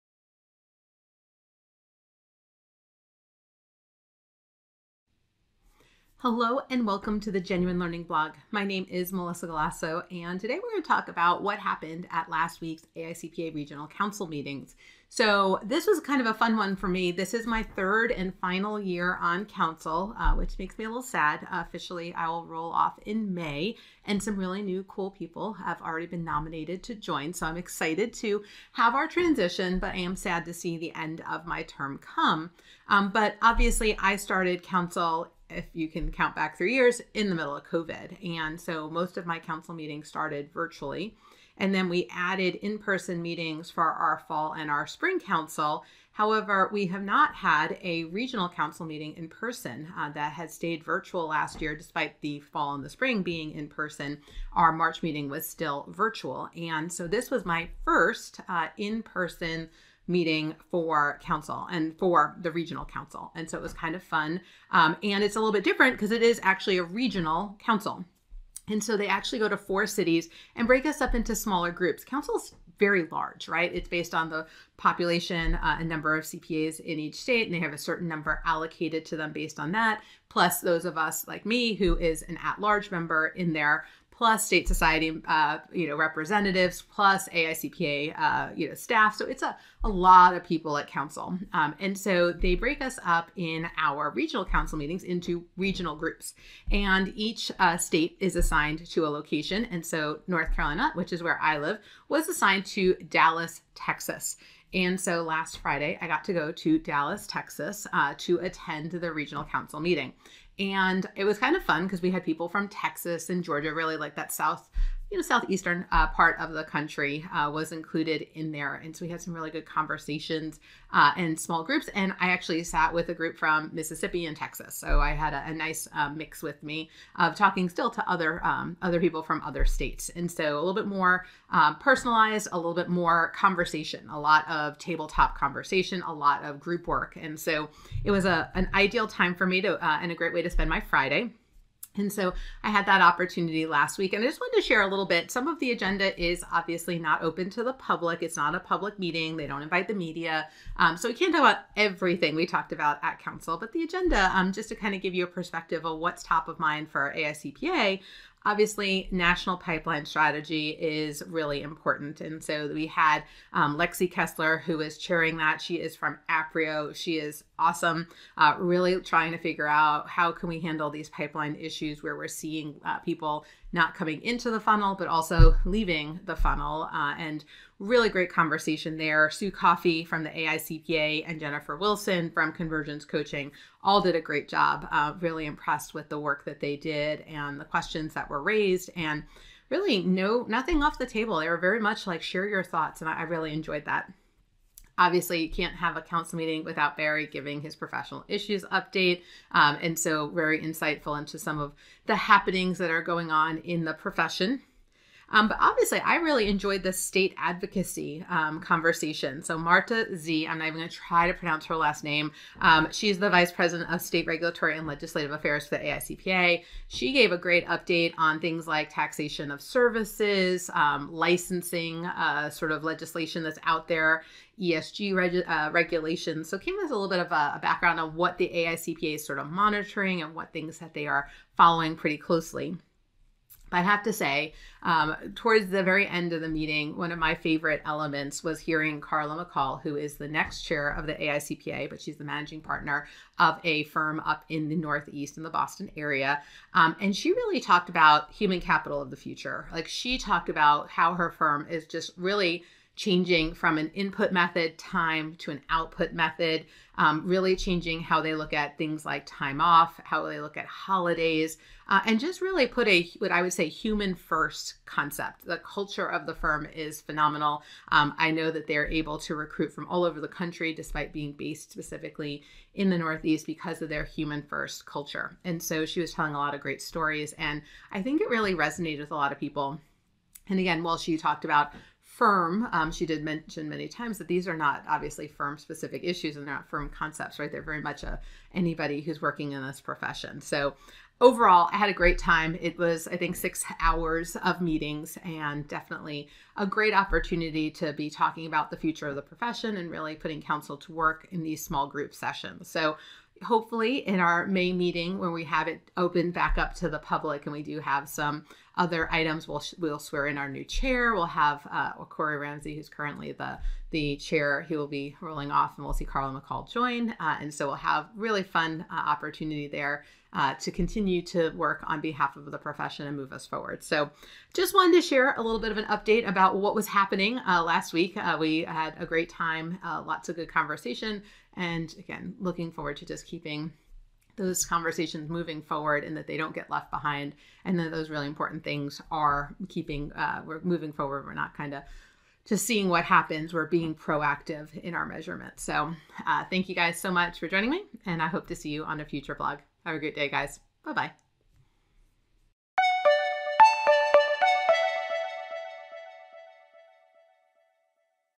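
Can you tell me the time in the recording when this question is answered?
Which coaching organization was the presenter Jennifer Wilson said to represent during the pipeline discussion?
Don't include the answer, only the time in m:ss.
3:02.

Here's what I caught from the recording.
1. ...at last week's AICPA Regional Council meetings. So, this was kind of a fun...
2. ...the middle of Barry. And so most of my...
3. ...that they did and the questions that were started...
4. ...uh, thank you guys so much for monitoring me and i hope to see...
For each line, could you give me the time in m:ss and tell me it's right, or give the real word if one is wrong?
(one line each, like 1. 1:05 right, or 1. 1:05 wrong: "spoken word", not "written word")
1. 0:12 right
2. 0:37 wrong: "COVID", not "Barry"
3. 3:06 wrong: "raised", not "started"
4. 5:46 wrong: "joining", not "monitoring".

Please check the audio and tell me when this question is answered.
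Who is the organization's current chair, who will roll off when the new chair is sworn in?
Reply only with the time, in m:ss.
5:11.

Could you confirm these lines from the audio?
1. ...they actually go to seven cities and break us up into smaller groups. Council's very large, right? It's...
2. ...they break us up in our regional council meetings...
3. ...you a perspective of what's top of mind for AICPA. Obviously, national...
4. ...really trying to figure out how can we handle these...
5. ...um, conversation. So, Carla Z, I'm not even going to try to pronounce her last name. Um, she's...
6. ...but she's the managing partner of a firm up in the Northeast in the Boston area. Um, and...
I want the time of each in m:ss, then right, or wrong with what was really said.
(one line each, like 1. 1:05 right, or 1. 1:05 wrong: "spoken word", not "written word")
1. 1:08 wrong: "four", not "seven"
2. 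1:32 right
3. 2:35 right
4. 2:48 right
5. 3:28 wrong: "Marta", not "Carla"
6. 4:01 right.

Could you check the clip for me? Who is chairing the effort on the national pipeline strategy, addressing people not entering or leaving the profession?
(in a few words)
Lexi Kessler.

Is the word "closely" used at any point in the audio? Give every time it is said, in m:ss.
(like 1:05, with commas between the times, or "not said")
3:52.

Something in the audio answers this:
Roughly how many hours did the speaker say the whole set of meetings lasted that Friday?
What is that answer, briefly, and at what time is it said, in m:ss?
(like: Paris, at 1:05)
6, at 4:53.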